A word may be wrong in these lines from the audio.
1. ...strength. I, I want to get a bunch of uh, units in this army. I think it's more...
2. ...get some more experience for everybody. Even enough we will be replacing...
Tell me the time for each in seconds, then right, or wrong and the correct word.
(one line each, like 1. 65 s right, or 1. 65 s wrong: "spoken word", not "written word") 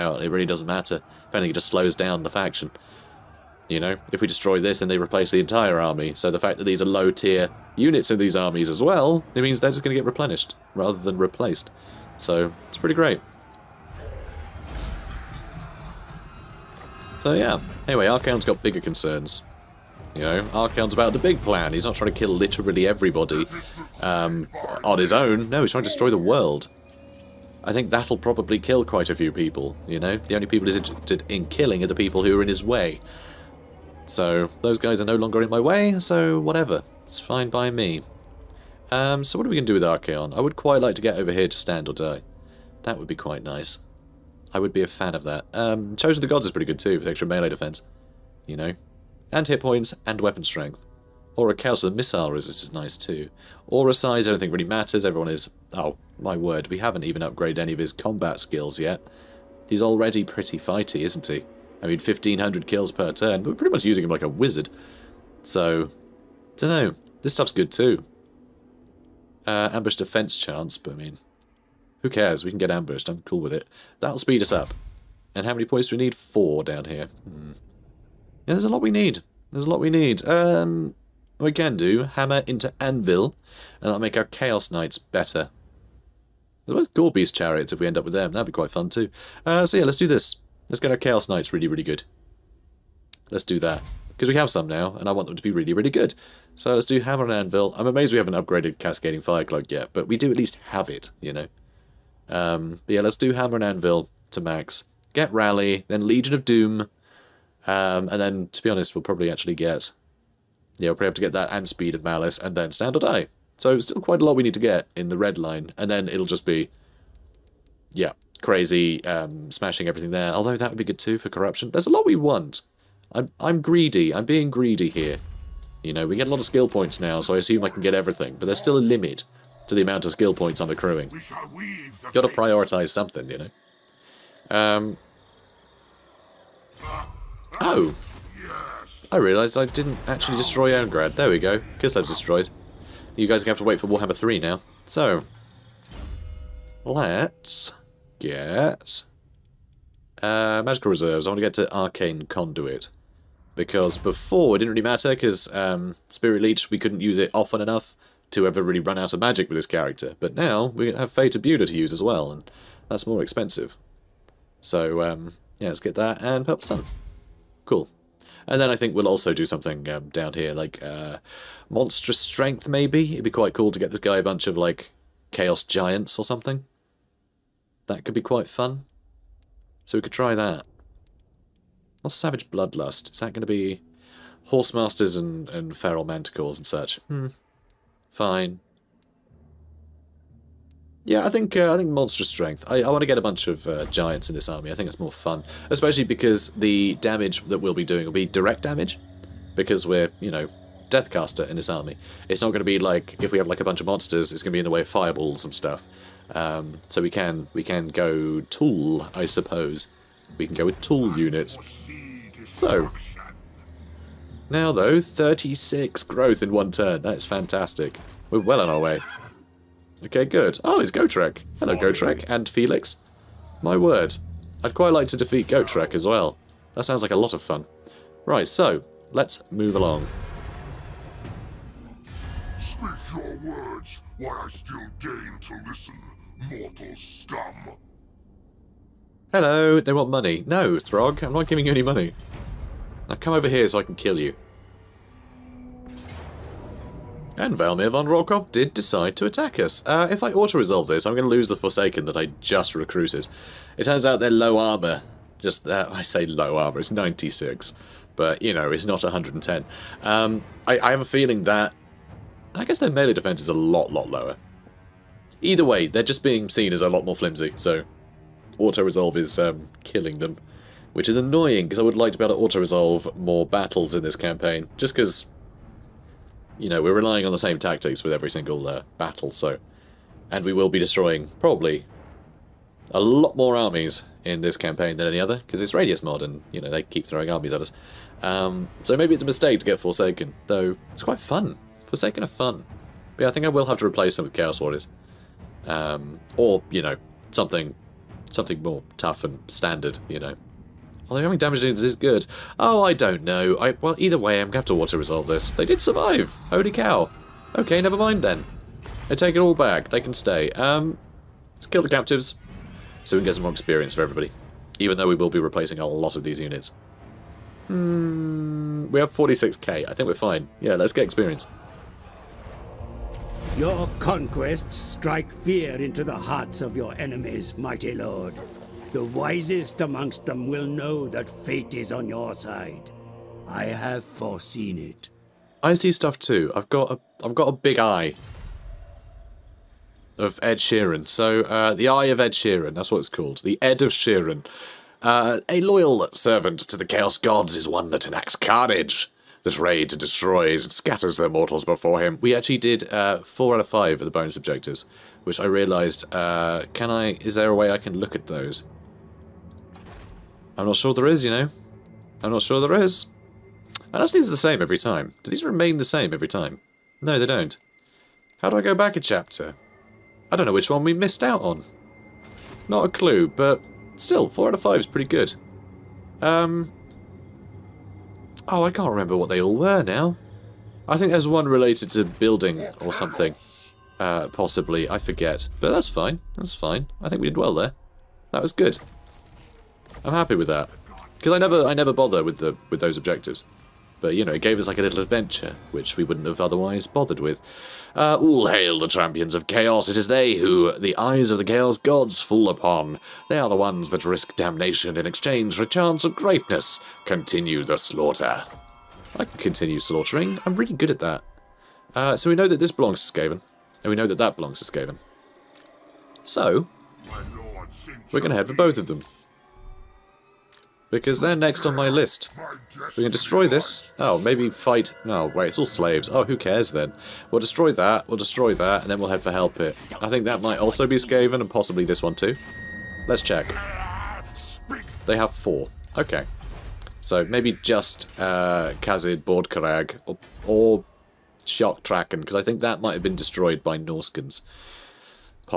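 1. 192 s wrong: "giants", not "units"
2. 313 s wrong: "though", not "enough".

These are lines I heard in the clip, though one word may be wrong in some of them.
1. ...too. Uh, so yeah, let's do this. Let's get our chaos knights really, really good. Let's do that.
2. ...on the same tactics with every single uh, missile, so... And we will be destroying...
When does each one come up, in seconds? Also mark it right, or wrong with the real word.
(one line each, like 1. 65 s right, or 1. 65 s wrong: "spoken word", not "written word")
1. 88 s right
2. 277 s wrong: "battle", not "missile".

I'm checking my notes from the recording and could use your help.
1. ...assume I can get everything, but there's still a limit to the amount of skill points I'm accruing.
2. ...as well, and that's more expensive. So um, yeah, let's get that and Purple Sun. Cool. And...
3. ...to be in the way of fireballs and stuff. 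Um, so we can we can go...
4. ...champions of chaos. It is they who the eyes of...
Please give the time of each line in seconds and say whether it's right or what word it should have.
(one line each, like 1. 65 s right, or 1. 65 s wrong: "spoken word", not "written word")
1. 127 s right
2. 161 s right
3. 204 s right
4. 398 s right.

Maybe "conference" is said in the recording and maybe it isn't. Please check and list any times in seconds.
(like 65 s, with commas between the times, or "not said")
not said.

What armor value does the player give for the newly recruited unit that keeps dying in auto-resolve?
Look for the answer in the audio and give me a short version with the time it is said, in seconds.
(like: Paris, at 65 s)
96, at 256 s.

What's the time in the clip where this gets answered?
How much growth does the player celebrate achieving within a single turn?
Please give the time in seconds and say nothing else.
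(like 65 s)
214 s.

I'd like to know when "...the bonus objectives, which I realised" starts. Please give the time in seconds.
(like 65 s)
354 s.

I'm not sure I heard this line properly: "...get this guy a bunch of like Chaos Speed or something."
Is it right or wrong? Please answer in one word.
wrong.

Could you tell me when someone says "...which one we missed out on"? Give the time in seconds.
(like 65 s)
370 s.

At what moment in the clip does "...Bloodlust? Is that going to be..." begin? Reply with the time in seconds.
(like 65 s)
182 s.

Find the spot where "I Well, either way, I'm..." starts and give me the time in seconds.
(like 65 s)
303 s.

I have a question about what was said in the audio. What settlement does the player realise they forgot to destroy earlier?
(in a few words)
Owngrad.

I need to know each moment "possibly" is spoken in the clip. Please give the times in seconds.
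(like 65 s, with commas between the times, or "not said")
384 s, 431 s.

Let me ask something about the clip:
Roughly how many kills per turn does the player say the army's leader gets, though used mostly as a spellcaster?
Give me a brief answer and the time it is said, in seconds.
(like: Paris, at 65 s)
1,500, at 61 s.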